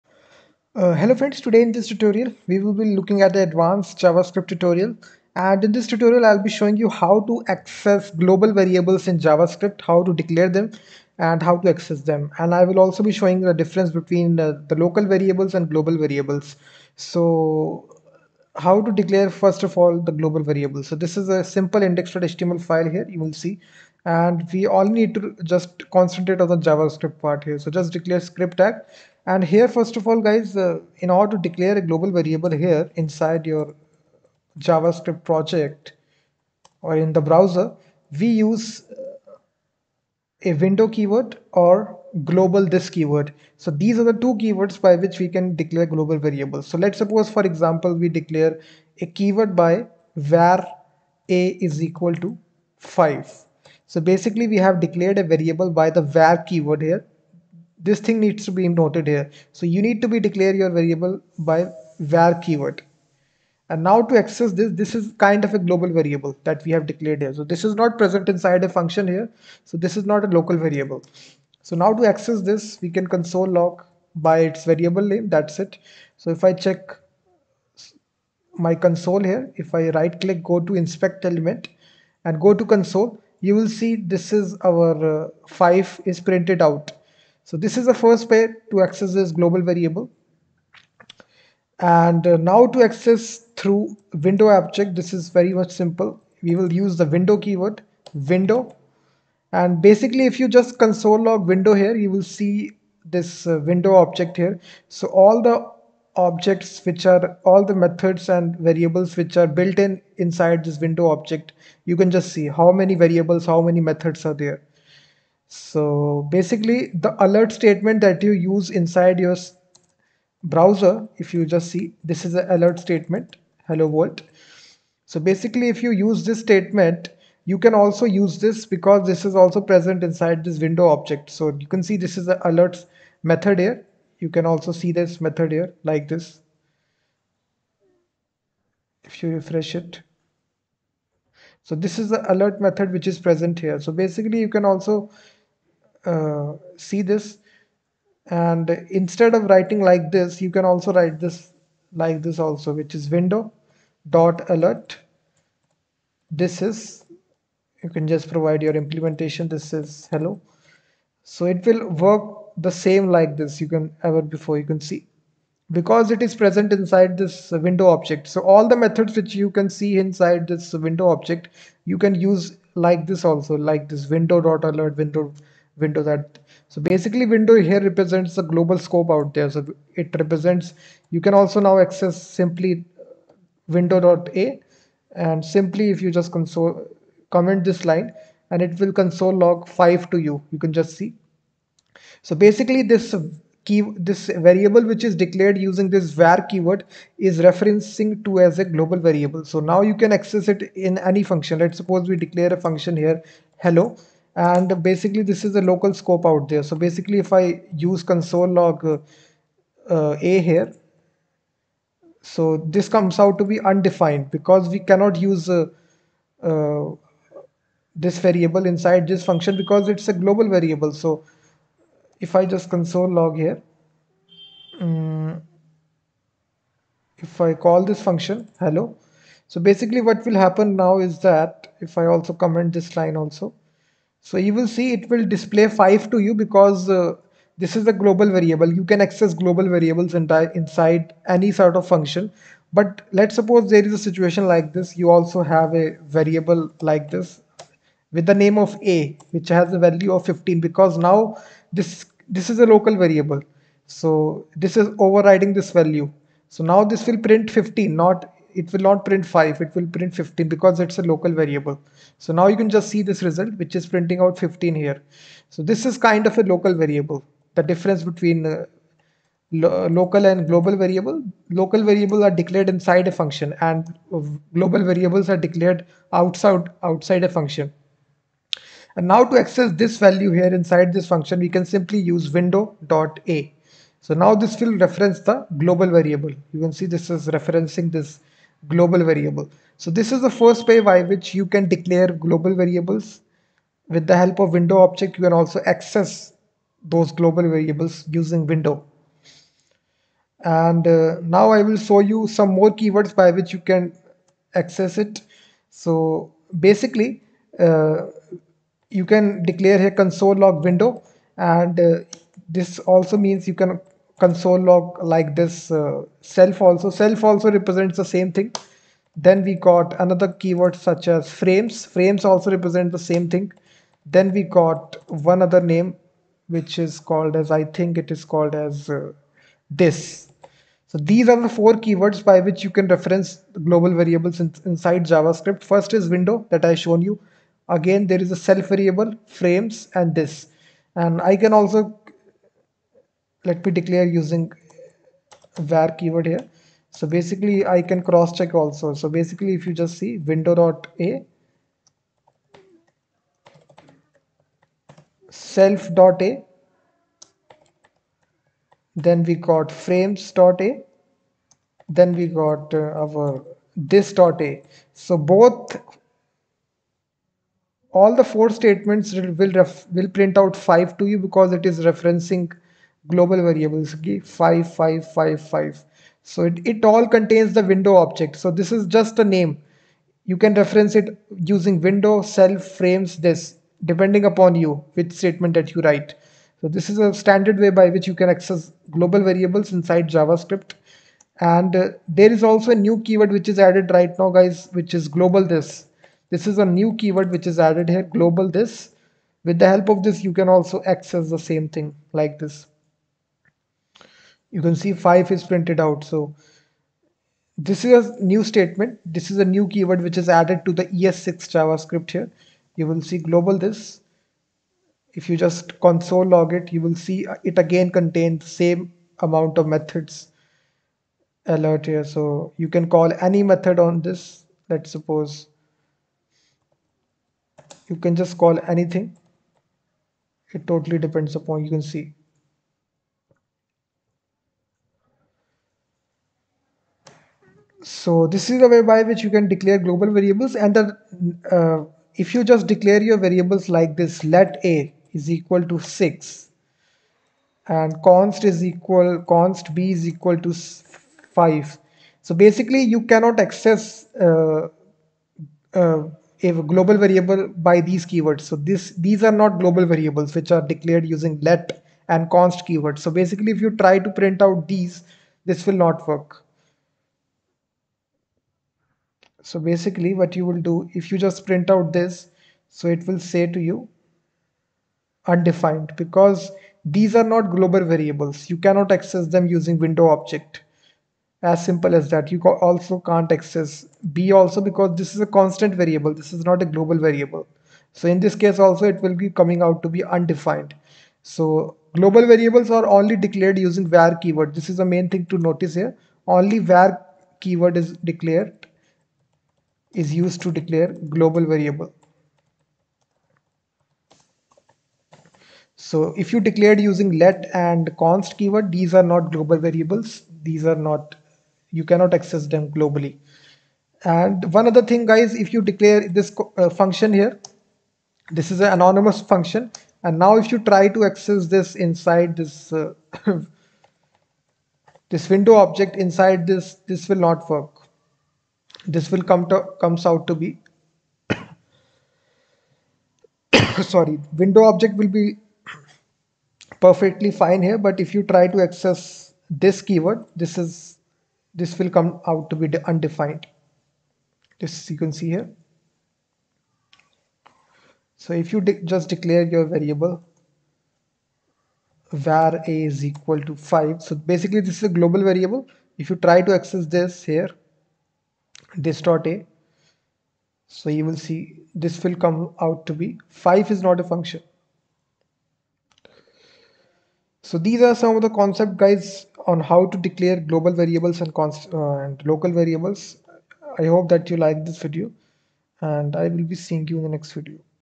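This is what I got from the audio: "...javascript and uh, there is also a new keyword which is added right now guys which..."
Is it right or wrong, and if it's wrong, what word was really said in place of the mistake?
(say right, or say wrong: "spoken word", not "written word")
right.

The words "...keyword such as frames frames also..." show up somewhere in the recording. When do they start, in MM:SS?
05:20.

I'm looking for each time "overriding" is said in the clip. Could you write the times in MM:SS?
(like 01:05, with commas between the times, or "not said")
04:15.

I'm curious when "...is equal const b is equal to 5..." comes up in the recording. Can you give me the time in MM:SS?
07:28.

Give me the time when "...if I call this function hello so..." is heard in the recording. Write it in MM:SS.
03:47.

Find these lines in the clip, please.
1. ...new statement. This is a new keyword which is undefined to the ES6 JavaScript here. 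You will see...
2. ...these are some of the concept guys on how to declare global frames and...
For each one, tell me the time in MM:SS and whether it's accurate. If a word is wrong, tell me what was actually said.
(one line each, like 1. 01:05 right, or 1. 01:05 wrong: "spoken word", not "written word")
1. 06:48 wrong: "added", not "undefined"
2. 09:27 wrong: "variables", not "frames".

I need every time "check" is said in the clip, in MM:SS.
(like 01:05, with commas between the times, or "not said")
01:16, 05:48.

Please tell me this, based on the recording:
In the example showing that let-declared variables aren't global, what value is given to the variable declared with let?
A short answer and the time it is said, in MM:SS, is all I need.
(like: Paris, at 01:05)
6, at 07:24.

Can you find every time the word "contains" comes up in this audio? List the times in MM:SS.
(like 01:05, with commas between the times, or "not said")
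06:17, 06:57.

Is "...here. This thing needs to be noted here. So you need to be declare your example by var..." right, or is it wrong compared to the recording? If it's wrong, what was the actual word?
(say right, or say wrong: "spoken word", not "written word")
wrong: "variable", not "example".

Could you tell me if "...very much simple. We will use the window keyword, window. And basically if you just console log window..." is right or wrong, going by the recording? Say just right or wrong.
right.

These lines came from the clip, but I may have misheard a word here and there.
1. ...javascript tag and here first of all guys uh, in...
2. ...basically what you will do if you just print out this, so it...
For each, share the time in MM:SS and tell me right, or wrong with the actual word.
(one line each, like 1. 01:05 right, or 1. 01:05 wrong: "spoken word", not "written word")
1. 00:28 wrong: "script", not "javascript"
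2. 07:49 right.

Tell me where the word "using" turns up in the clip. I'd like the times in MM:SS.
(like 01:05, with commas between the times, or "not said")
03:15, 04:58, 05:44, 06:21, 07:41, 07:59, 08:13, 08:26.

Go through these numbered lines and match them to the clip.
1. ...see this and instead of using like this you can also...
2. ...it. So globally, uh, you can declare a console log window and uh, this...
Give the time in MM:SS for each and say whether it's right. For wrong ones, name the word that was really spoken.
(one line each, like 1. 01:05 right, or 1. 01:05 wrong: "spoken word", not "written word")
1. 02:26 wrong: "writing", not "using"
2. 05:04 wrong: "basically", not "globally".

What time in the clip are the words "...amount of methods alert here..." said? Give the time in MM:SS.
06:59.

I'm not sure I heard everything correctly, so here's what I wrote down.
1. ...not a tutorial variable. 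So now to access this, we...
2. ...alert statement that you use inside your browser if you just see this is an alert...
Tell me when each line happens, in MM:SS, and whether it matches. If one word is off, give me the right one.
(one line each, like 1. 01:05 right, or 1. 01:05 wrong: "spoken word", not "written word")
1. 01:10 wrong: "local", not "tutorial"
2. 01:57 right.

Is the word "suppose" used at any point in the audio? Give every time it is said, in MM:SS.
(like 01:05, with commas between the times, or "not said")
00:46, 03:21, 04:03, 07:04.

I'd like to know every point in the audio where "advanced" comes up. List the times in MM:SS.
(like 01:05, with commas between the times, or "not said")
00:03.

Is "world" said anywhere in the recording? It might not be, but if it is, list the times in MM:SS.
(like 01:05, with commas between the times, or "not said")
02:03.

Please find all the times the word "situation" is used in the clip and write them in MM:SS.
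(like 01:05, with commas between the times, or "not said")
04:04.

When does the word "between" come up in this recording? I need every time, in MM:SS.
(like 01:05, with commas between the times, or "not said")
00:13, 04:28.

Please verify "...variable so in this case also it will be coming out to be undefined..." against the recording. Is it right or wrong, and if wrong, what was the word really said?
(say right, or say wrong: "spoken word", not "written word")
right.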